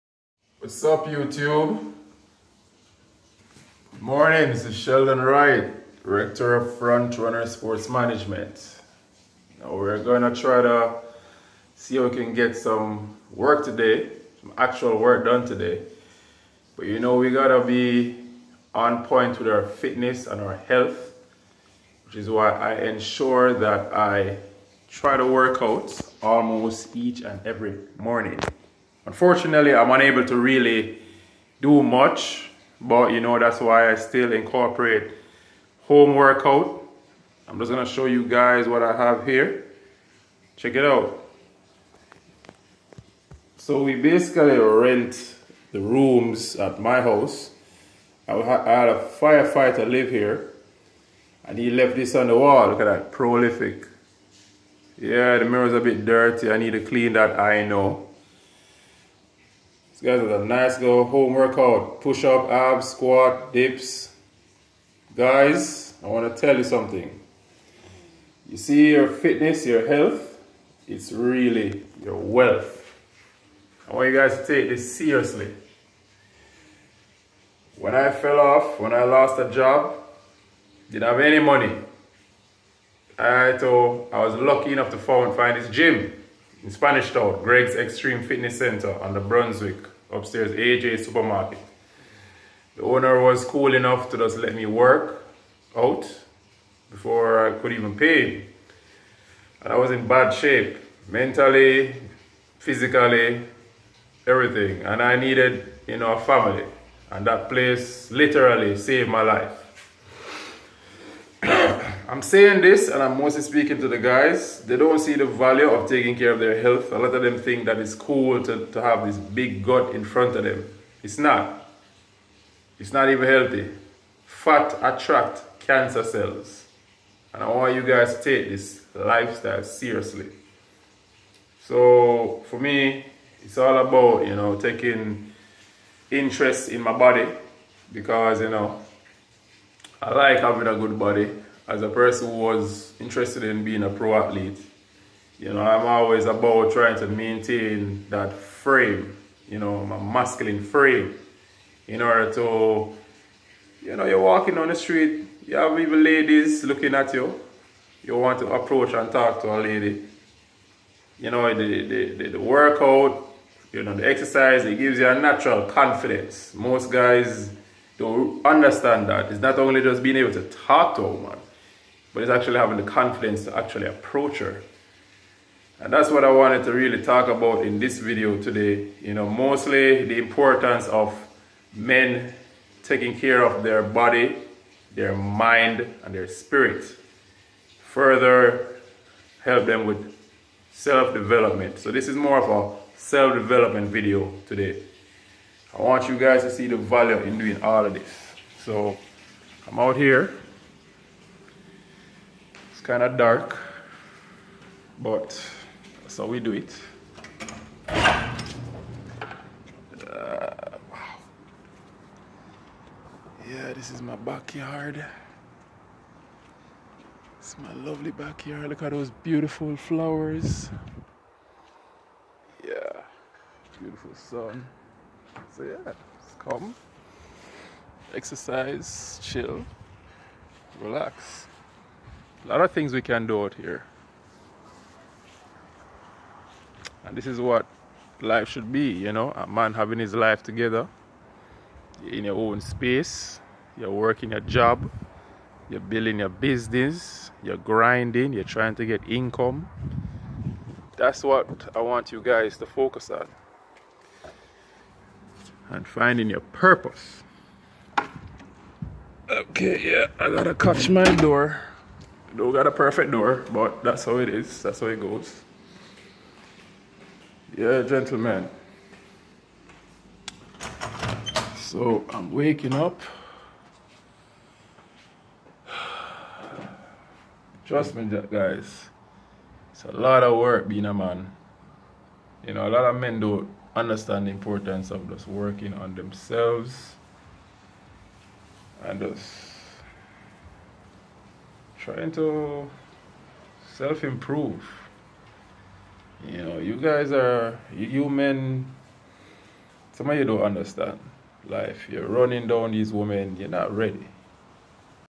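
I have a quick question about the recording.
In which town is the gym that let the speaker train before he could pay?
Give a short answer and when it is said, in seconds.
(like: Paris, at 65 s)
Spanish Town, at 86 s.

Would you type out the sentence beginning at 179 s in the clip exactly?
You know, mostly the importance of men taking care of their body, their mind, and their spirit.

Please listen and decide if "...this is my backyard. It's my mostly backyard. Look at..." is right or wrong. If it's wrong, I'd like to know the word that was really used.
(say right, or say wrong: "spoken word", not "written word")
wrong: "lovely", not "mostly".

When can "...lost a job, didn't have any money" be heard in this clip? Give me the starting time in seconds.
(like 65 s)
79 s.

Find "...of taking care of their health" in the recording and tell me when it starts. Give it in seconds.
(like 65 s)
115 s.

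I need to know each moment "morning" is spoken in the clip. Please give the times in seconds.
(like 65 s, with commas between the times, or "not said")
3 s, 27 s.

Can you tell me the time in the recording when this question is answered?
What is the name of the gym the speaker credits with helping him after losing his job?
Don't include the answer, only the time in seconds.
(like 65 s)
87 s.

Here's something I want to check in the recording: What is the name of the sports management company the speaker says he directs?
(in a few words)
Front Runner Sports Management.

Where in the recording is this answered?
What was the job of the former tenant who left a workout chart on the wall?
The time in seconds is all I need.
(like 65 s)
49 s.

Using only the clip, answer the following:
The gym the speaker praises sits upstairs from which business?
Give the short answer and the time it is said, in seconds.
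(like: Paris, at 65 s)
AJ Supermarket, at 90 s.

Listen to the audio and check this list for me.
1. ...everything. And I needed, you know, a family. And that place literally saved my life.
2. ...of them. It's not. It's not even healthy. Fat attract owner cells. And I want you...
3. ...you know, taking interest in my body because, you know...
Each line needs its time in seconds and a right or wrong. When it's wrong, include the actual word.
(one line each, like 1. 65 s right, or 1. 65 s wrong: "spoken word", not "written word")
1. 104 s right
2. 120 s wrong: "cancer", not "owner"
3. 134 s right.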